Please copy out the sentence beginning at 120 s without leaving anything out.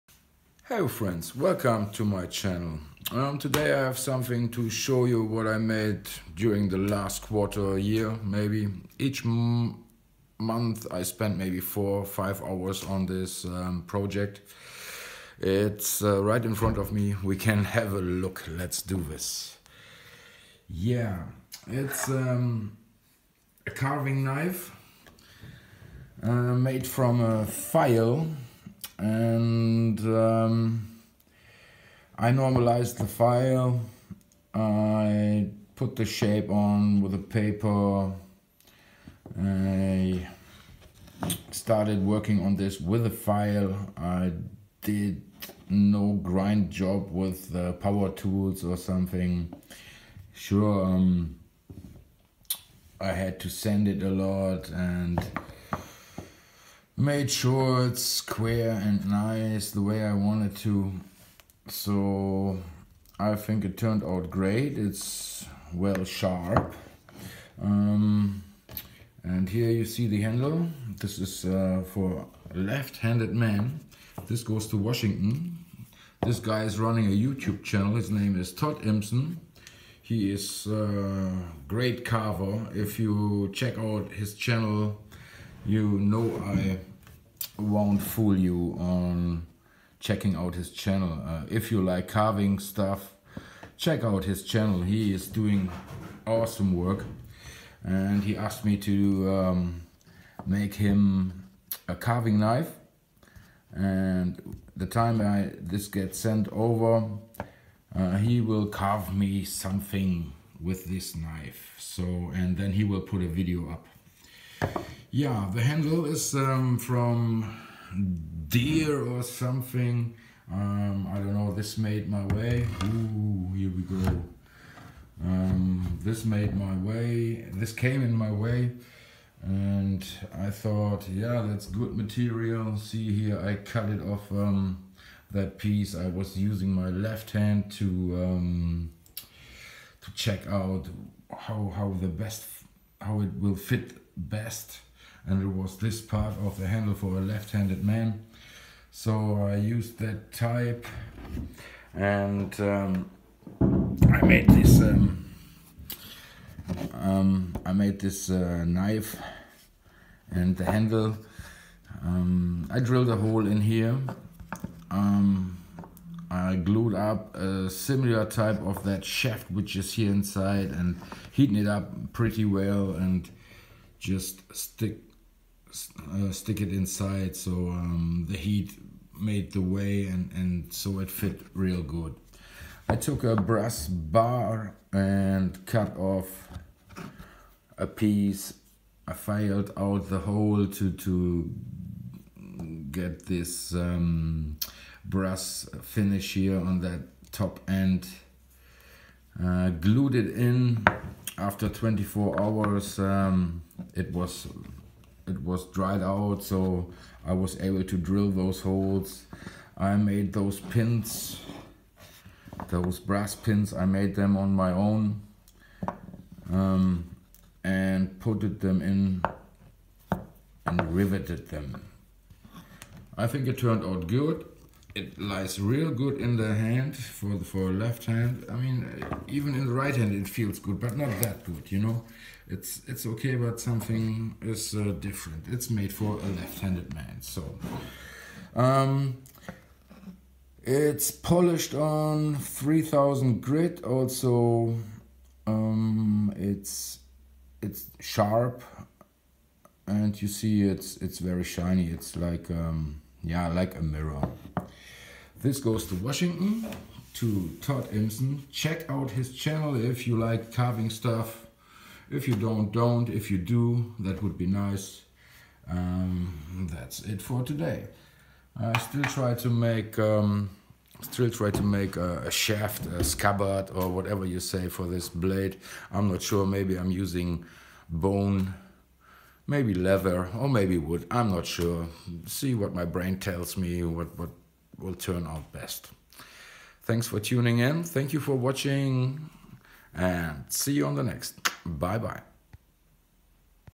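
Um, I don't know, this made my way.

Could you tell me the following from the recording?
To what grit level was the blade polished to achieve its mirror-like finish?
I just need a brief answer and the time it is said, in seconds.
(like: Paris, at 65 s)
3000, at 242 s.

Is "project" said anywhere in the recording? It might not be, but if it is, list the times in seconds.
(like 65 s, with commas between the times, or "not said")
13 s.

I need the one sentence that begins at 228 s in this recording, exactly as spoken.
I mean, even in the right hand it feels good, but not that good.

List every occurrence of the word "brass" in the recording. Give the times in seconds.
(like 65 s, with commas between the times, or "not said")
183 s, 195 s, 212 s.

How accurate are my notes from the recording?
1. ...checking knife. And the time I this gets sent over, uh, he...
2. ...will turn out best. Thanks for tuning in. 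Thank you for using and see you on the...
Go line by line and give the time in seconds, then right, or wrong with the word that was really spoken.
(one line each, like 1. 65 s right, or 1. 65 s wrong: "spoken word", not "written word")
1. 101 s wrong: "carving", not "checking"
2. 284 s wrong: "watching", not "using".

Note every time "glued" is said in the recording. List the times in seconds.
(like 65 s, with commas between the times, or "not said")
166 s, 199 s.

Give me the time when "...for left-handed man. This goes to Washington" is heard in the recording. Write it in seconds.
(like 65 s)
71 s.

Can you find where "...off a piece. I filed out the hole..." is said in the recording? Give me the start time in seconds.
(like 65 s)
185 s.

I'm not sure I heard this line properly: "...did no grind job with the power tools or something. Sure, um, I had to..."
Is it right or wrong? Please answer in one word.
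right.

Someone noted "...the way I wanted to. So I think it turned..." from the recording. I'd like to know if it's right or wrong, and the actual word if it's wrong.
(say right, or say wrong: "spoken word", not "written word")
right.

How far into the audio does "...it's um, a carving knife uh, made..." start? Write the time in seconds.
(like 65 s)
21 s.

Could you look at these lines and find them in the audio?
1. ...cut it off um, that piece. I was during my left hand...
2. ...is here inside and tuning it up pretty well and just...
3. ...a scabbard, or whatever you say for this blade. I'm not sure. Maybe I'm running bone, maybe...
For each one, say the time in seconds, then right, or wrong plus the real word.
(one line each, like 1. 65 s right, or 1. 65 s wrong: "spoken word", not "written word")
1. 133 s wrong: "using", not "during"
2. 169 s wrong: "heating", not "tuning"
3. 272 s wrong: "using", not "running".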